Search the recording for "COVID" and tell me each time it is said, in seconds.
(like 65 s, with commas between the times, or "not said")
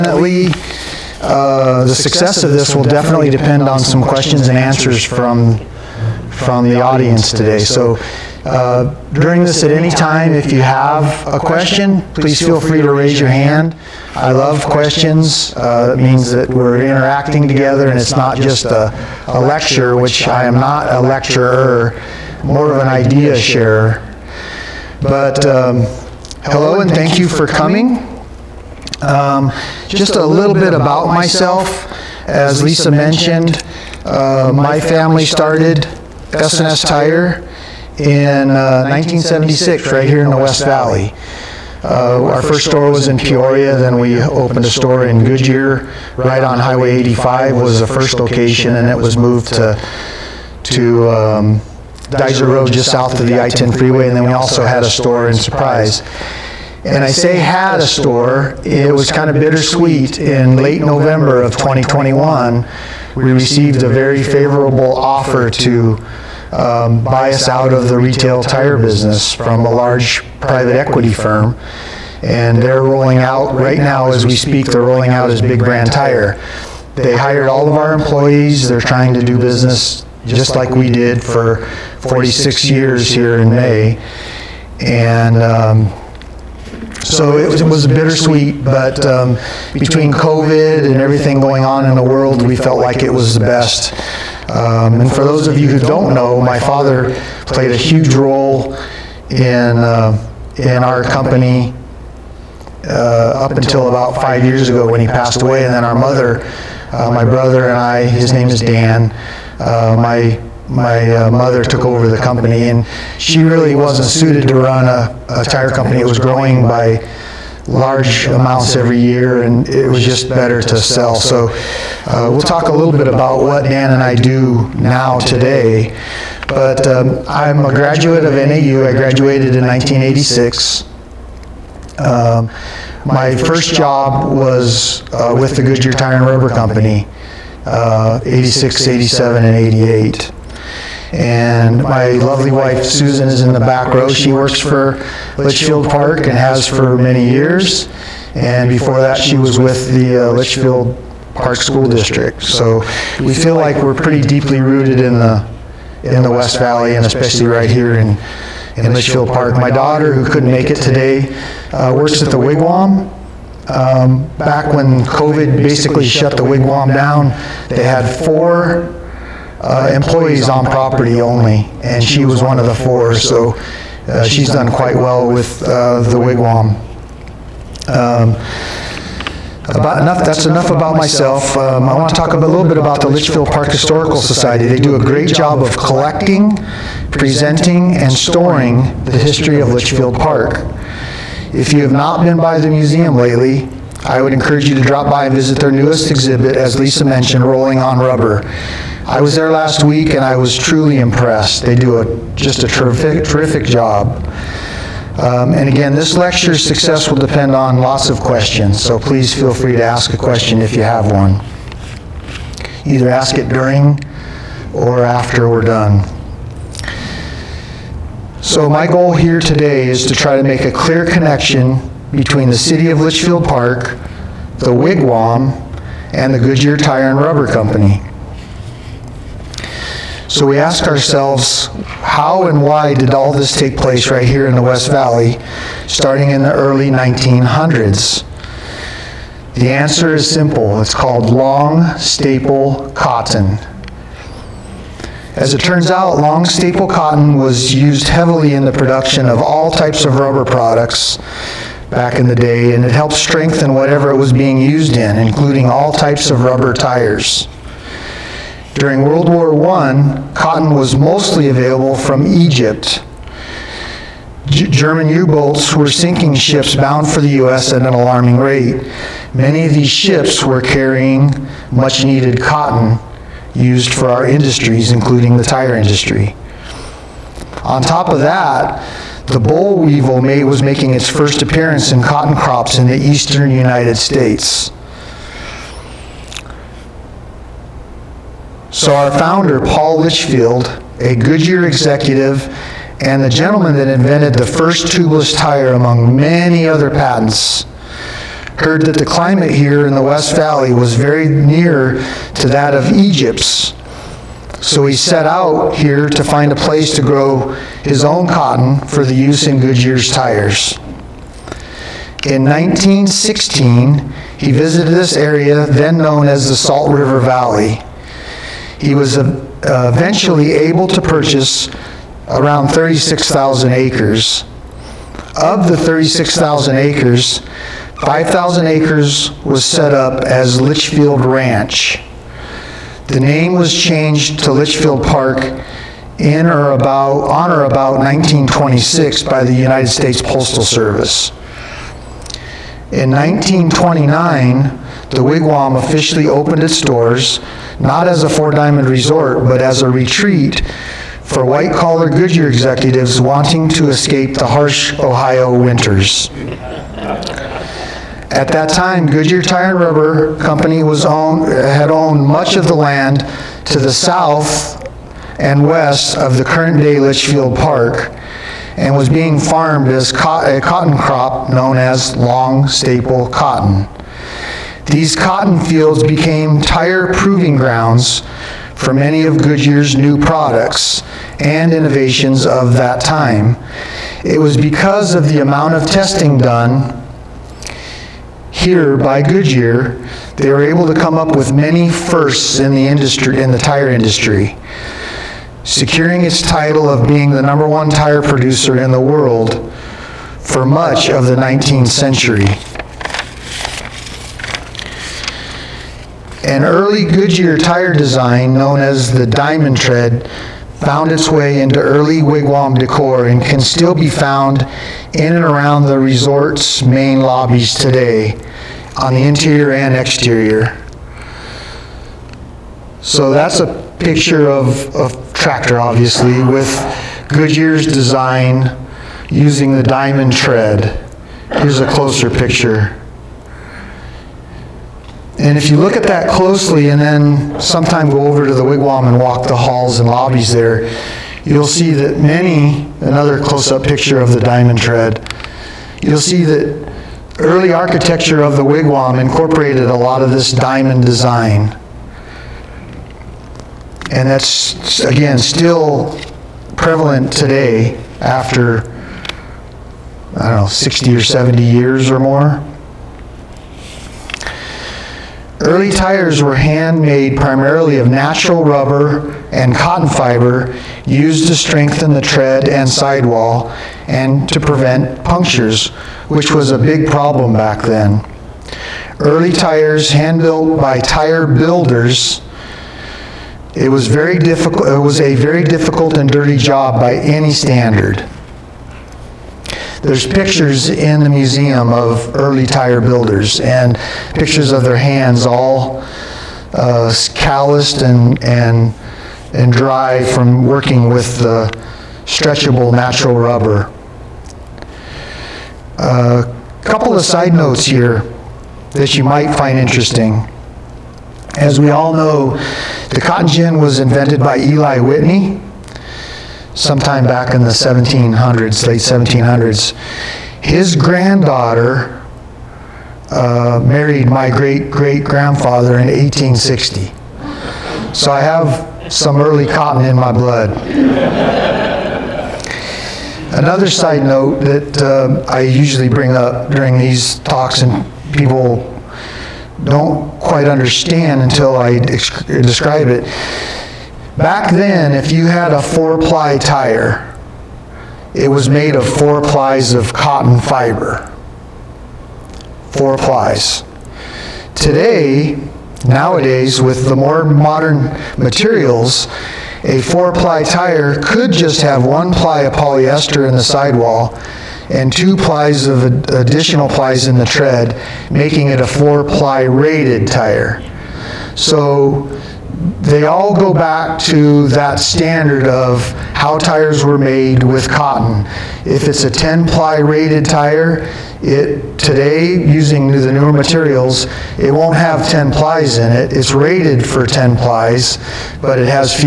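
90 s, 165 s.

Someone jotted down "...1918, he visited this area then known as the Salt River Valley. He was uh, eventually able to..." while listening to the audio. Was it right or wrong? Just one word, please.
wrong.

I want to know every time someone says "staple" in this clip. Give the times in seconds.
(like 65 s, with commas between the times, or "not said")
241 s, 246 s, 372 s.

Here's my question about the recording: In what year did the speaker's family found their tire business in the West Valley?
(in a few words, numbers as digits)
1976.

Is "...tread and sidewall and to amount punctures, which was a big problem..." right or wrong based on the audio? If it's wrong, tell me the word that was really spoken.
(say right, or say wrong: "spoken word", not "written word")
wrong: "prevent", not "amount".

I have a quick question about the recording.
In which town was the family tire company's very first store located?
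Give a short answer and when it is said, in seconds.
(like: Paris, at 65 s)
Peoria, at 43 s.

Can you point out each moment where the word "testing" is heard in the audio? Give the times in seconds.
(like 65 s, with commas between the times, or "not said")
385 s.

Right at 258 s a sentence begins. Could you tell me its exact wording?
During World War I, cotton was mostly available from Egypt.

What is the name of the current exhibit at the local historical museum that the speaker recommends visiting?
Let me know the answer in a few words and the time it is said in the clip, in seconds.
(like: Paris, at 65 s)
Rolling on Rubber, at 197 s.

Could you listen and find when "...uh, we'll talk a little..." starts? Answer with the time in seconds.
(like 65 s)
122 s.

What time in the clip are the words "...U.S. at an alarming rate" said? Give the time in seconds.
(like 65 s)
267 s.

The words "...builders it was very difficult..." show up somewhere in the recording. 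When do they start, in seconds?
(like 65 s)
481 s.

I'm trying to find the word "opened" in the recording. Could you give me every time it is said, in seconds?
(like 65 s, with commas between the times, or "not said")
44 s, 346 s.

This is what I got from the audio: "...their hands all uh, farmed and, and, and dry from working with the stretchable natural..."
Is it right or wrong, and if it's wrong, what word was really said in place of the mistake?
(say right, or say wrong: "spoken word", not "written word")
wrong: "calloused", not "farmed".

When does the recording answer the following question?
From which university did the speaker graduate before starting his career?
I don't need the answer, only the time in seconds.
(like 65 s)
128 s.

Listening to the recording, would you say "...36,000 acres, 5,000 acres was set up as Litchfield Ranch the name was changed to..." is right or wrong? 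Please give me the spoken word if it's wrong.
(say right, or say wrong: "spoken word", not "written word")
right.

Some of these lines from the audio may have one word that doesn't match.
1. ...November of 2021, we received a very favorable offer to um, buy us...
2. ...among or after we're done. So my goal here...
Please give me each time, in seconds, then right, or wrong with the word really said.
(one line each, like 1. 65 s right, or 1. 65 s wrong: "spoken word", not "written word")
1. 60 s right
2. 213 s wrong: "during", not "among".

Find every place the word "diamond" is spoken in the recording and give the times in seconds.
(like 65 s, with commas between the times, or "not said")
348 s, 409 s, 429 s, 444 s, 450 s.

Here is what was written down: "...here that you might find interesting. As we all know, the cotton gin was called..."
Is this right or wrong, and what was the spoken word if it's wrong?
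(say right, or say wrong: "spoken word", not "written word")
wrong: "invented", not "called".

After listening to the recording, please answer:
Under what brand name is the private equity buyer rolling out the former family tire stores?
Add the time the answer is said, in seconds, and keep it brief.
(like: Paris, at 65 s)
Big Brand Tire, at 75 s.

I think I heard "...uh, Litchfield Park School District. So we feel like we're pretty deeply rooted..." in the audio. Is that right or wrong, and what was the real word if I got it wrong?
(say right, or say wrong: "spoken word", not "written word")
right.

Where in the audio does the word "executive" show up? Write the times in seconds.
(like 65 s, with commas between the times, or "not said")
291 s, 352 s.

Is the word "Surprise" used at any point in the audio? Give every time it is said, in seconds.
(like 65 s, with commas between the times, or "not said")
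55 s.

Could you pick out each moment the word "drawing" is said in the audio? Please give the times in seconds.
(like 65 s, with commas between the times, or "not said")
not said.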